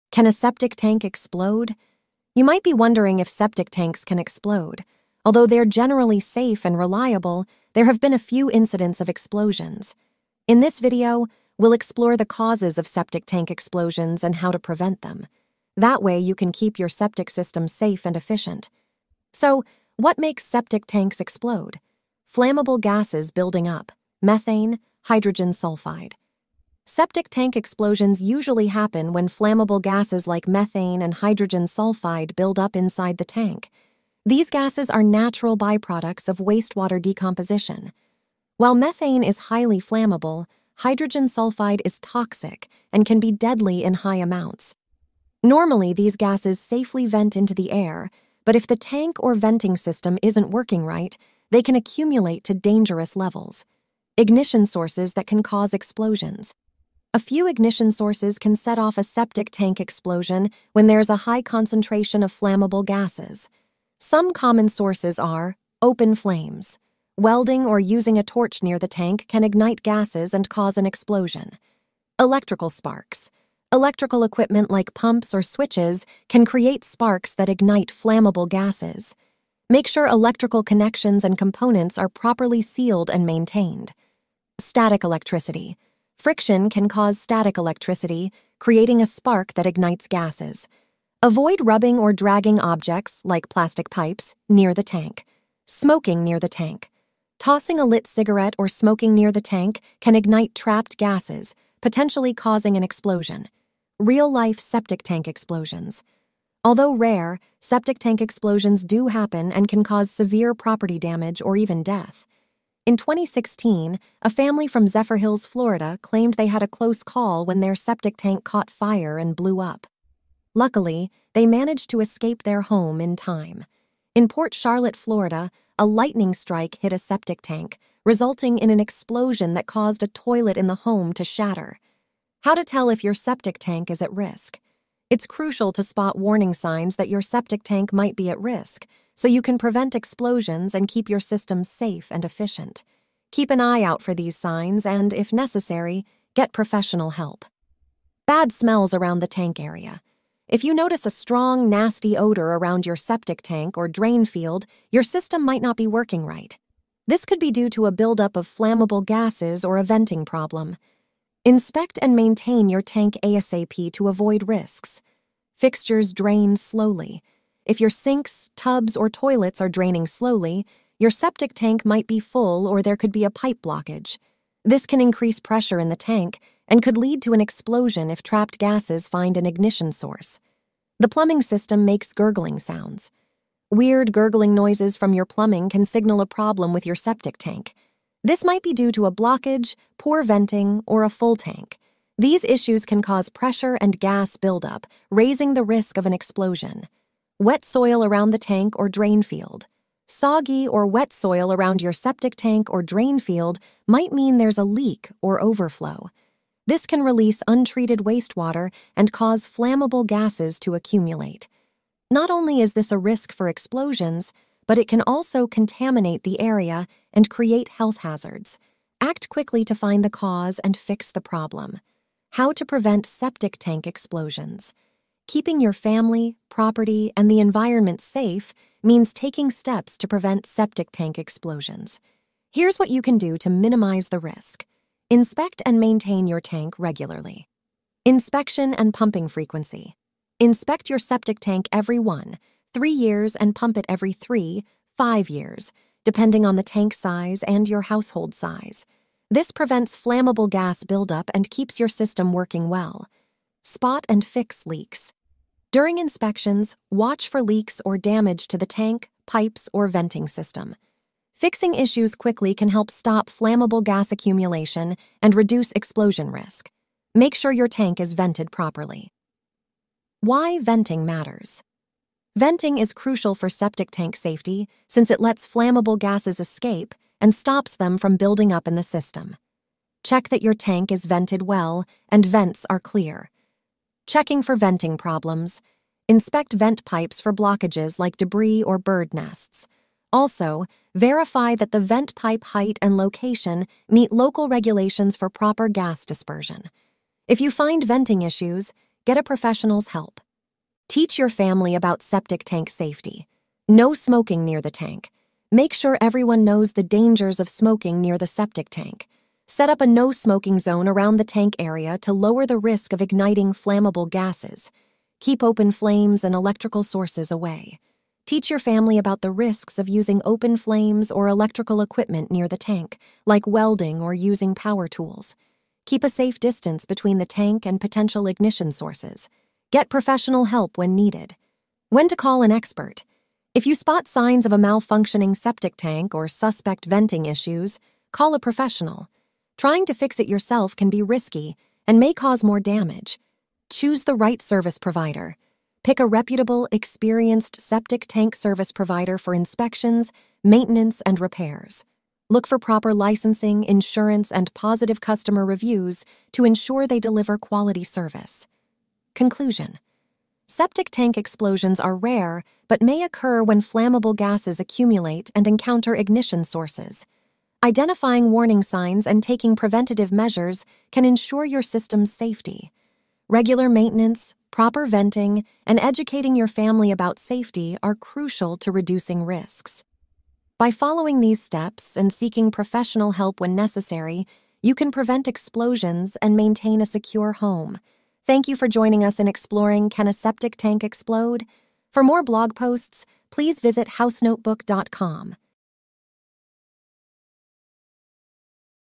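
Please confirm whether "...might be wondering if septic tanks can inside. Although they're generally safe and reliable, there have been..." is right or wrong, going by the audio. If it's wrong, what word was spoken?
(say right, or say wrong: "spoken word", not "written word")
wrong: "explode", not "inside".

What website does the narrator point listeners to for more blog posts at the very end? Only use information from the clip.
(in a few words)
housenotebook.com.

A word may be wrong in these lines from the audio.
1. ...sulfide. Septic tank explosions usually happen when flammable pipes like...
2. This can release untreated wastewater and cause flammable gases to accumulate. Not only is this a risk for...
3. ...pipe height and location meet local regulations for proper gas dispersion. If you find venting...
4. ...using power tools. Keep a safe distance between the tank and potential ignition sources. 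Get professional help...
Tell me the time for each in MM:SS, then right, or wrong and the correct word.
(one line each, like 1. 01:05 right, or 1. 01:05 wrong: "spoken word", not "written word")
1. 00:25 wrong: "gases", not "pipes"
2. 03:26 right
3. 04:52 right
4. 05:24 right.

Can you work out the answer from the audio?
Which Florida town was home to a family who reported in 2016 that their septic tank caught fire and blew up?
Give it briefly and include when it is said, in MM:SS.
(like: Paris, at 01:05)
Zephyrhills, at 01:54.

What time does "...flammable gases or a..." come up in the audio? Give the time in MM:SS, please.
02:38.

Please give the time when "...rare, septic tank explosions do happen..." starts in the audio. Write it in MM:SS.
01:46.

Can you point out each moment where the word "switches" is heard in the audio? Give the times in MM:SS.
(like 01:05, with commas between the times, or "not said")
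01:15.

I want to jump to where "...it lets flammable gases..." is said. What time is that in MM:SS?
04:35.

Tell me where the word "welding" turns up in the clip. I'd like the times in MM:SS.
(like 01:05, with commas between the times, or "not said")
01:07, 05:23.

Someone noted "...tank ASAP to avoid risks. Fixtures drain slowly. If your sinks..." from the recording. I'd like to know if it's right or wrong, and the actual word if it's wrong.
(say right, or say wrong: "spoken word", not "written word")
right.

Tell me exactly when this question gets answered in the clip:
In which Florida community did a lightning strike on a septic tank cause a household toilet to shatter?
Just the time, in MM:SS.
02:04.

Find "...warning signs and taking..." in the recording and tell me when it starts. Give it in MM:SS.
06:08.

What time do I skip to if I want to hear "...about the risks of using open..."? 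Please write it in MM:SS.
05:18.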